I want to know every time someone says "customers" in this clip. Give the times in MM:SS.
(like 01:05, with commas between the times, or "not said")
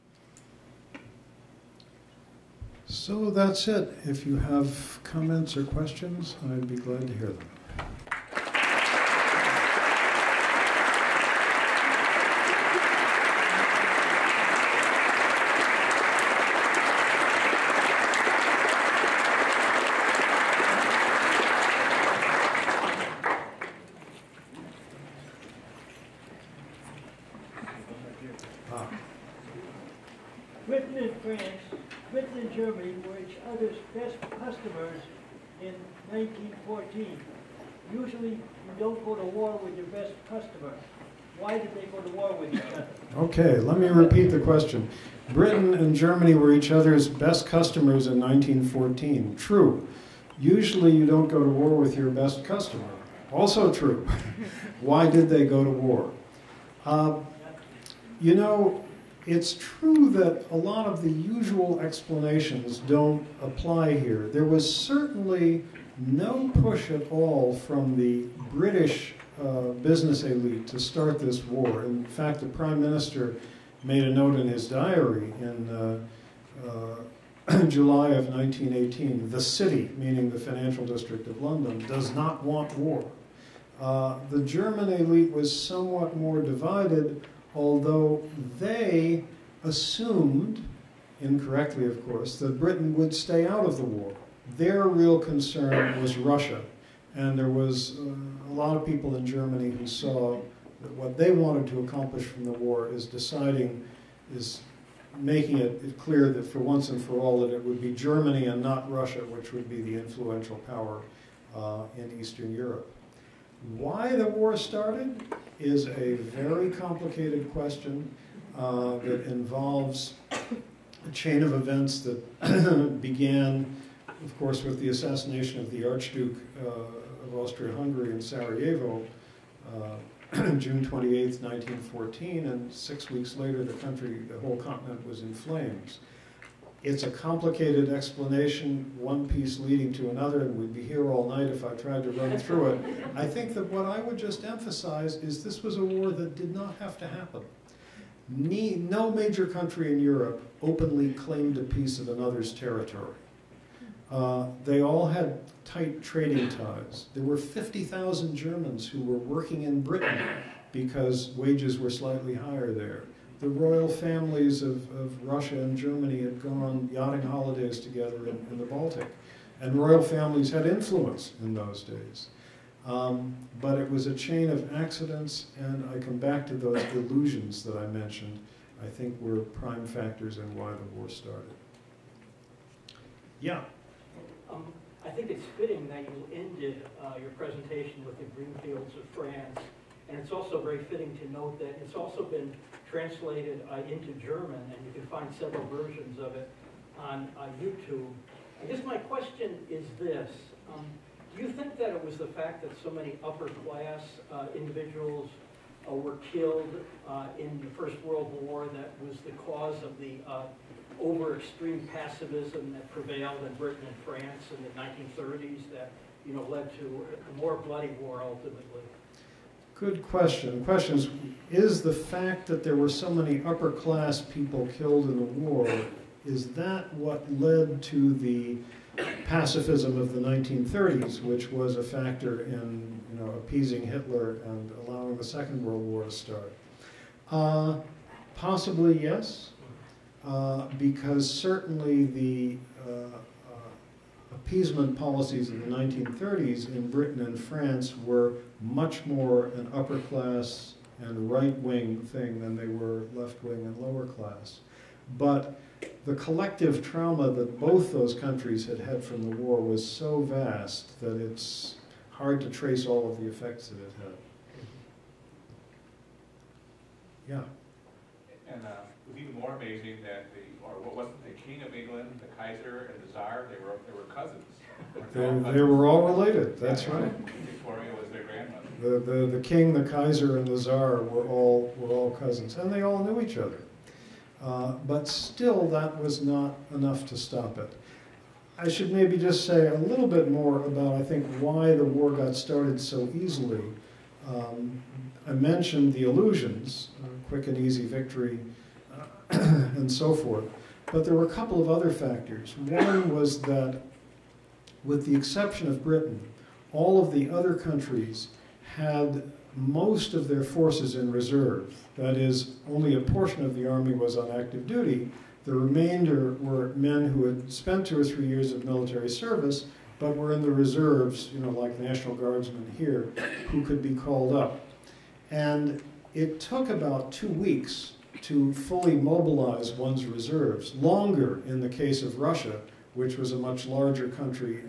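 00:34, 00:40, 00:47, 00:52.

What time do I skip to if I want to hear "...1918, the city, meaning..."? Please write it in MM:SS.
01:18.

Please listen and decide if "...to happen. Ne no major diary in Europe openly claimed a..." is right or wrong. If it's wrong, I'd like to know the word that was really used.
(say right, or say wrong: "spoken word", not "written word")
wrong: "country", not "diary".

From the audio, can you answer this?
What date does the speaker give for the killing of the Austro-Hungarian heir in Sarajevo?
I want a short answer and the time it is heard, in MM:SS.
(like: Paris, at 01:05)
June 28, 1914, at 02:10.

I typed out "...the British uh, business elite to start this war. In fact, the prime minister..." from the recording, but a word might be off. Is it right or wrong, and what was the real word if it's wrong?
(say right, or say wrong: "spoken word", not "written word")
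right.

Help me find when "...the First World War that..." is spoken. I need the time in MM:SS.
03:27.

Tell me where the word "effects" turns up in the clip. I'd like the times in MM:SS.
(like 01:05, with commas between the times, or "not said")
04:23.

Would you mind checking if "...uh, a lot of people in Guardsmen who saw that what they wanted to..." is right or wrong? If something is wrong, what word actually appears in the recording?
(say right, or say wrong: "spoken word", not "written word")
wrong: "Germany", not "Guardsmen".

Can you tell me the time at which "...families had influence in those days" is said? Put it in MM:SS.
02:50.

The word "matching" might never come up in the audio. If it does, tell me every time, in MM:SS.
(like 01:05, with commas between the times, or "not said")
not said.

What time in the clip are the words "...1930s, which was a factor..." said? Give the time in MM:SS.
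03:50.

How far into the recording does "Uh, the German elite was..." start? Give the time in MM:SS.
01:23.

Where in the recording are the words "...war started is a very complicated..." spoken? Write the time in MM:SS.
01:54.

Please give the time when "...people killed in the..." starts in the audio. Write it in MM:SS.
03:44.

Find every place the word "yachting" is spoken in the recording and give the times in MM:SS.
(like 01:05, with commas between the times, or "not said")
02:46.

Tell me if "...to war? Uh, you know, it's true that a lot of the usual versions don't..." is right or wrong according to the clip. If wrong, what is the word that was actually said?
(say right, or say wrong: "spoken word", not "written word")
wrong: "explanations", not "versions".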